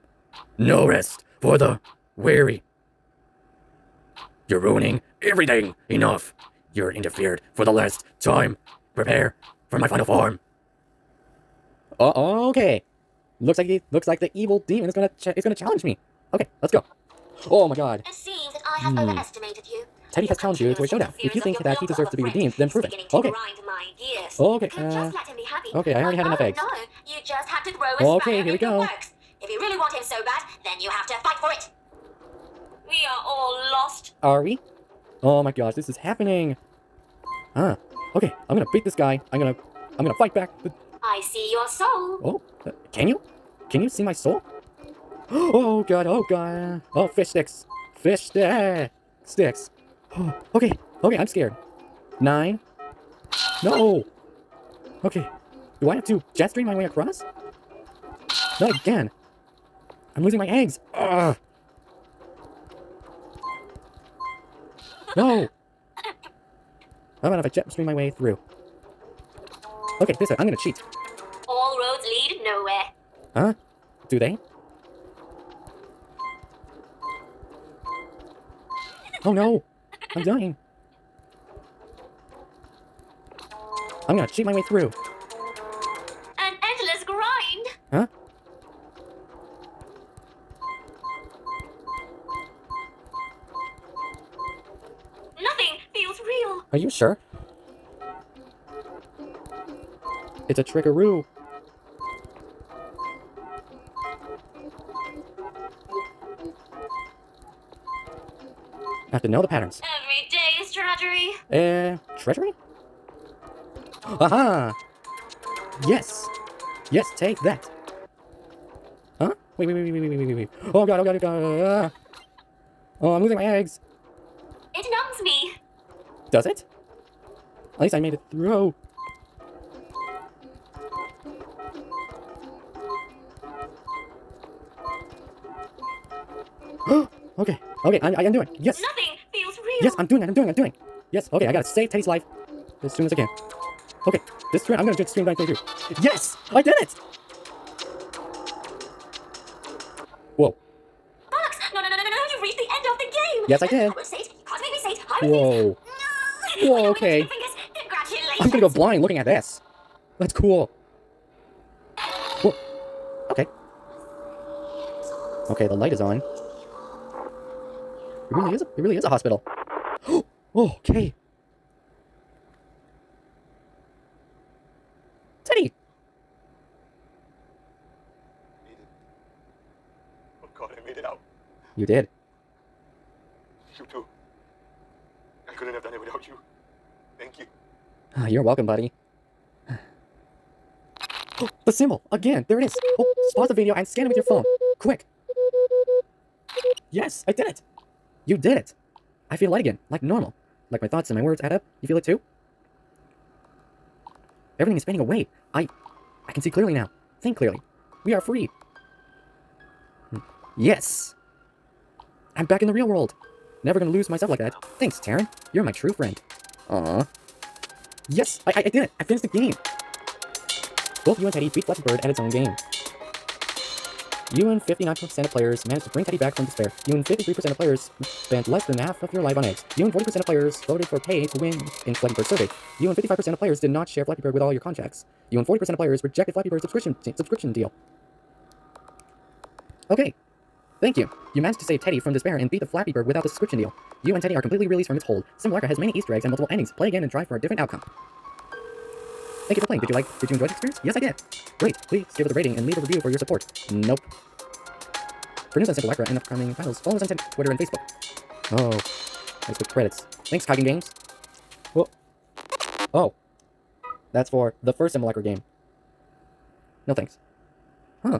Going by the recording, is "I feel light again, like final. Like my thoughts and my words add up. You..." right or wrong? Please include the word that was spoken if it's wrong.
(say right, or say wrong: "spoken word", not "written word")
wrong: "normal", not "final".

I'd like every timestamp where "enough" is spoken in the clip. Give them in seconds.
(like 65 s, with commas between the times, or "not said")
5 s, 26 s.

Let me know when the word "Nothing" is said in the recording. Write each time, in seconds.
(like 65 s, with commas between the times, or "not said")
95 s, 138 s.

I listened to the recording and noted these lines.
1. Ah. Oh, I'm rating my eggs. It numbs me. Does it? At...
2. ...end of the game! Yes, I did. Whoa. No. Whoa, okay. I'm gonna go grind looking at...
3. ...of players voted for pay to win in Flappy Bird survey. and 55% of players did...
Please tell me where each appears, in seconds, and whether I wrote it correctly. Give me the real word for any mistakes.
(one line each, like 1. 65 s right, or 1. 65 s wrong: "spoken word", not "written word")
1. 121 s wrong: "losing", not "rating"
2. 152 s wrong: "blind", not "grind"
3. 230 s right.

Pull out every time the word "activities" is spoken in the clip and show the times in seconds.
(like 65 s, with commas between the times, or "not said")
not said.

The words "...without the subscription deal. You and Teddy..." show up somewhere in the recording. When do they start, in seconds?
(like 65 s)
243 s.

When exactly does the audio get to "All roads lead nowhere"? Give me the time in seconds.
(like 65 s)
71 s.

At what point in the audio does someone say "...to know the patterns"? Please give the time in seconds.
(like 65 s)
109 s.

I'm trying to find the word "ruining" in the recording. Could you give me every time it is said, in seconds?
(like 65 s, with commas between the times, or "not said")
4 s.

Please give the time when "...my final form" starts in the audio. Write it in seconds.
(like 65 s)
9 s.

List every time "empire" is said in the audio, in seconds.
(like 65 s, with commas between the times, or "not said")
not said.